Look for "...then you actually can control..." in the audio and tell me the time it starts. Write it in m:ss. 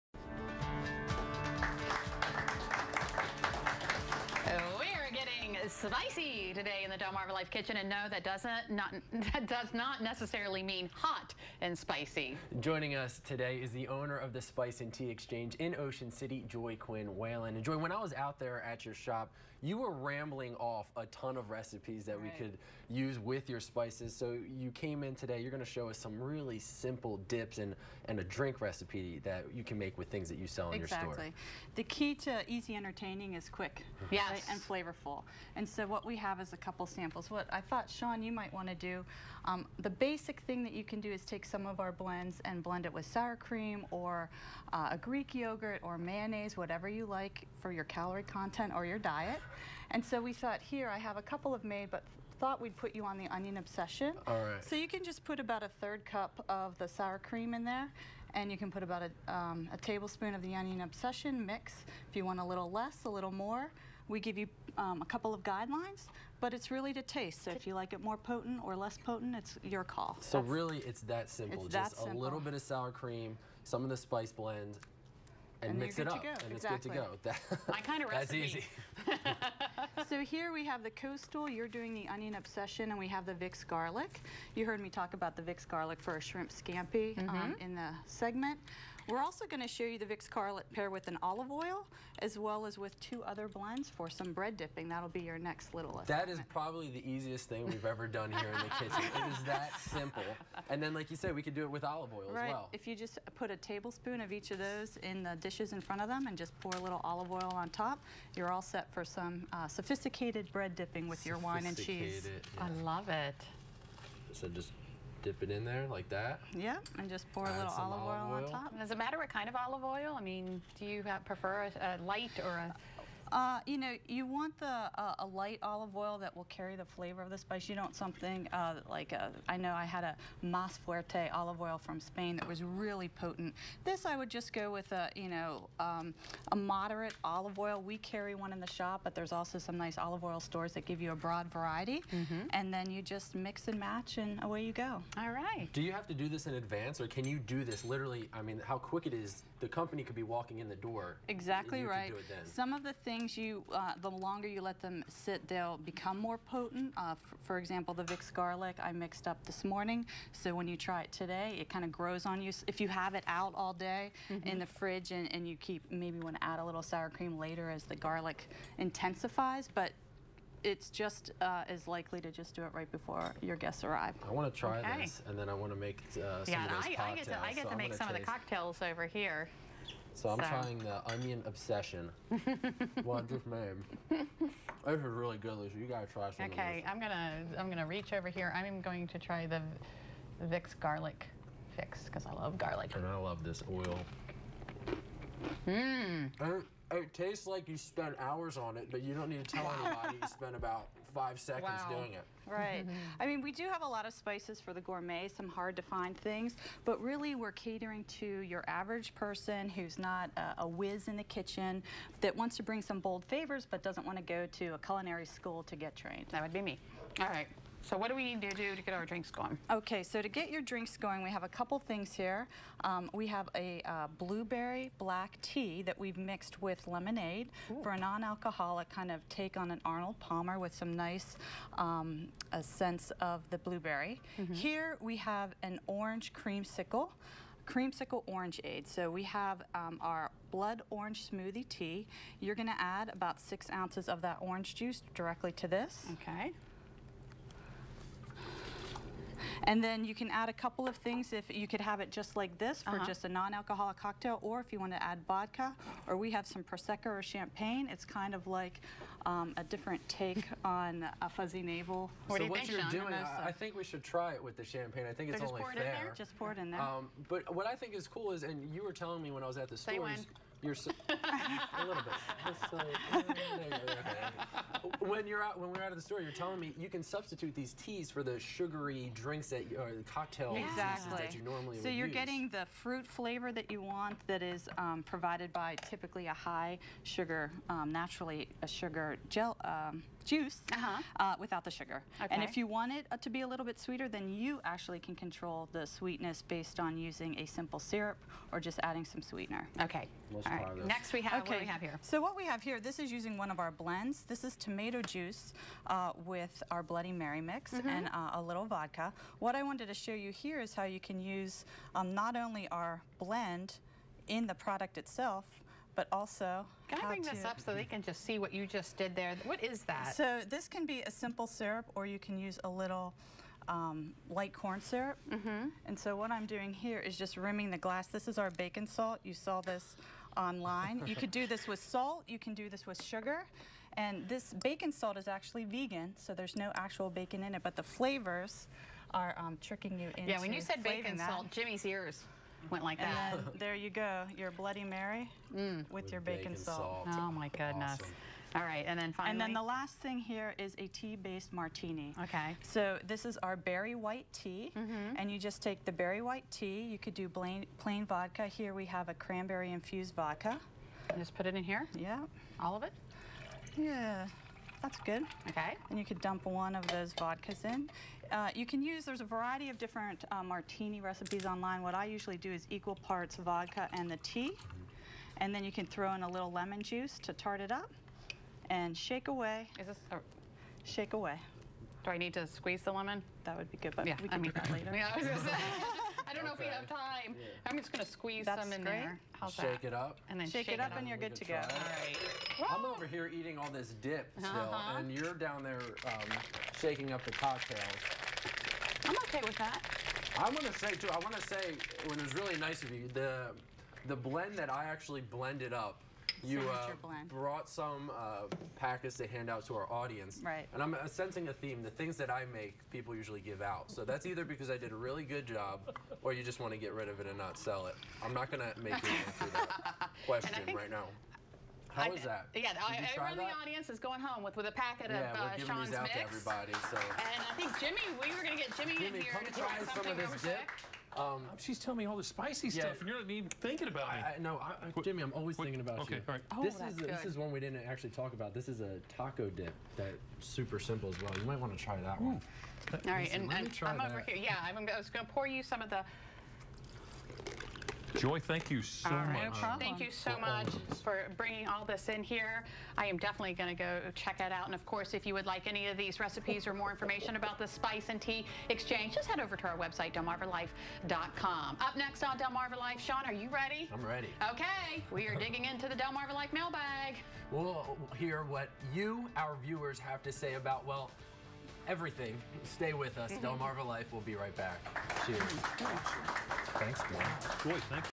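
4:54.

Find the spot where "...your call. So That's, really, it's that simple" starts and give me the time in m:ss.
1:09.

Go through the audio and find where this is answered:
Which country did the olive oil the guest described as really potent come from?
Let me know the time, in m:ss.
2:12.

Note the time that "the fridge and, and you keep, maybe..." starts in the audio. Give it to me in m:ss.
2:44.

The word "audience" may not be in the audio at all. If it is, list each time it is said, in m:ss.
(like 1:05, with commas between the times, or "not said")
6:49, 7:03.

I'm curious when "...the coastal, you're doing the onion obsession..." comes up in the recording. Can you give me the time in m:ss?
1:20.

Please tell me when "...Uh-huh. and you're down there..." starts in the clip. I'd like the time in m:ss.
6:34.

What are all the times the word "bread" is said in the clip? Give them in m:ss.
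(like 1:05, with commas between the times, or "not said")
1:34, 1:50.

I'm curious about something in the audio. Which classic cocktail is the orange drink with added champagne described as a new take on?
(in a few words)
Fuzzy navel.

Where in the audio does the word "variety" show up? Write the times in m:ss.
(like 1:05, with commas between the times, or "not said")
2:21, 6:09.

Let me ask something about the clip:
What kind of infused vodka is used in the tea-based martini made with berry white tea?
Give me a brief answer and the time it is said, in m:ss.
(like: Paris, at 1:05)
Cranberry, at 5:59.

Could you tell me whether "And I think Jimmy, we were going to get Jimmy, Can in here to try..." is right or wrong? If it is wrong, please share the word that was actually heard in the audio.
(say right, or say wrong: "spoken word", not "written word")
wrong: "Jimmy", not "Can".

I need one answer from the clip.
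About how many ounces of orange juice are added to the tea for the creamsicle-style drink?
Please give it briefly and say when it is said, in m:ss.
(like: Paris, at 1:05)
6 ounces, at 4:03.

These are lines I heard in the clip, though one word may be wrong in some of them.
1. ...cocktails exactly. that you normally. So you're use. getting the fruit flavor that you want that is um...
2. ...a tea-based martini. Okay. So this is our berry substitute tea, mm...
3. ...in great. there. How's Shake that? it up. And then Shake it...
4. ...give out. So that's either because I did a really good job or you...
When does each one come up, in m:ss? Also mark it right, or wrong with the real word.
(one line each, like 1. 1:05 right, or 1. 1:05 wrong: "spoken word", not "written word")
1. 4:40 right
2. 5:50 wrong: "white", not "substitute"
3. 6:28 right
4. 6:53 right.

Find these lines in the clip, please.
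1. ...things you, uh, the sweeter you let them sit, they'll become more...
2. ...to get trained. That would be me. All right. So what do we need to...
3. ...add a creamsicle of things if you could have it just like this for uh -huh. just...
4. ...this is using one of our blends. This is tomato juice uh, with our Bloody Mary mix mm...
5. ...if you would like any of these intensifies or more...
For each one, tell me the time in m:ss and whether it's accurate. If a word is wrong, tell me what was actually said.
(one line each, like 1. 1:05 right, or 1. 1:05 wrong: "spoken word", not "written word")
1. 2:33 wrong: "longer", not "sweeter"
2. 3:35 right
3. 4:10 wrong: "couple", not "creamsicle"
4. 5:02 right
5. 7:35 wrong: "recipes", not "intensifies".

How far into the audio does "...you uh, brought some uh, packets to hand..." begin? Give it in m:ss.
6:46.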